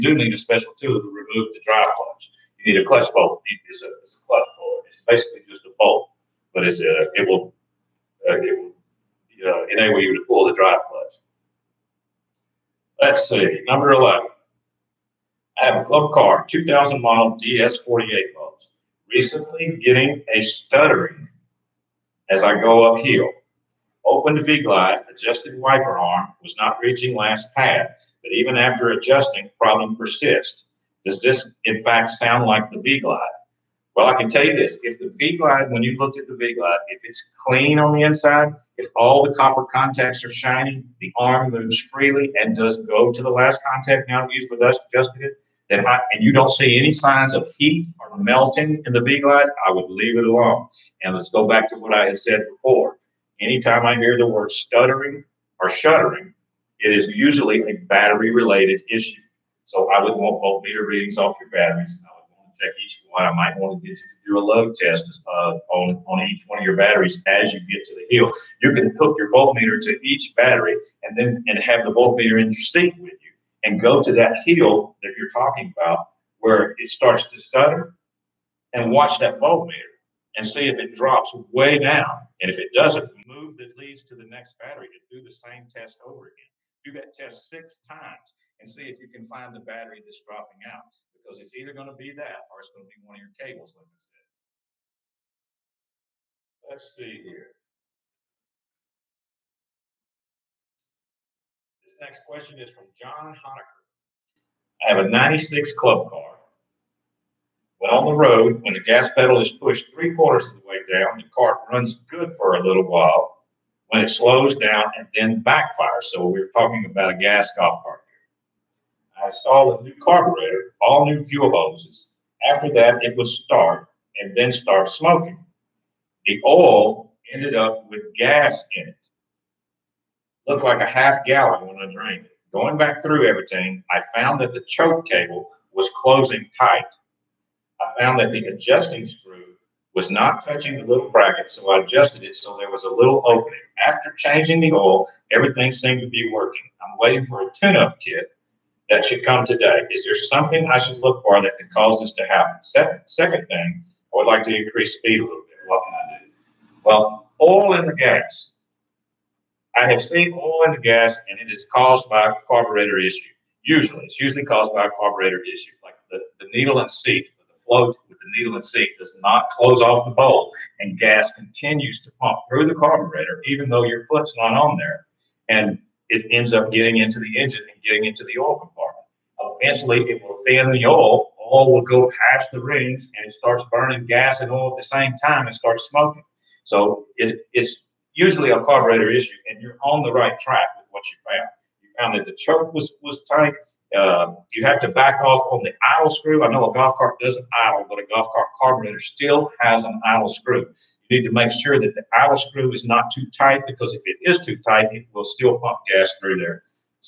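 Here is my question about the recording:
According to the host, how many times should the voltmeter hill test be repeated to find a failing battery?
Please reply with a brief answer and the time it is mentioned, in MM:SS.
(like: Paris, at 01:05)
6, at 01:27.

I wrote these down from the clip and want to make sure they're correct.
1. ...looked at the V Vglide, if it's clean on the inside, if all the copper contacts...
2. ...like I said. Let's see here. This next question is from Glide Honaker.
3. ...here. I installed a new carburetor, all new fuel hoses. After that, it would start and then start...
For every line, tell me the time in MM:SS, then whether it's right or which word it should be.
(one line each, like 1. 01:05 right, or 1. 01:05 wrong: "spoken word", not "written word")
1. 00:35 wrong: "Glide", not "Vglide"
2. 01:33 wrong: "John", not "Glide"
3. 01:58 right.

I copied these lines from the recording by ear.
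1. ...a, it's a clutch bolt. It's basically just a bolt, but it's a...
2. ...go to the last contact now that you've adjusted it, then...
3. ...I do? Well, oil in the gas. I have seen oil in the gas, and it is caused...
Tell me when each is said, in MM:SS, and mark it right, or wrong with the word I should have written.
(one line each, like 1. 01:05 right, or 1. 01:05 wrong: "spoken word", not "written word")
1. 00:03 right
2. 00:42 right
3. 02:35 right.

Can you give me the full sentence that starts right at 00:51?
And let's go back to what I had said before.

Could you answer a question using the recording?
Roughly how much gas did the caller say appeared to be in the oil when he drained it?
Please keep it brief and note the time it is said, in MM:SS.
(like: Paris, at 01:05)
half gallon, at 02:10.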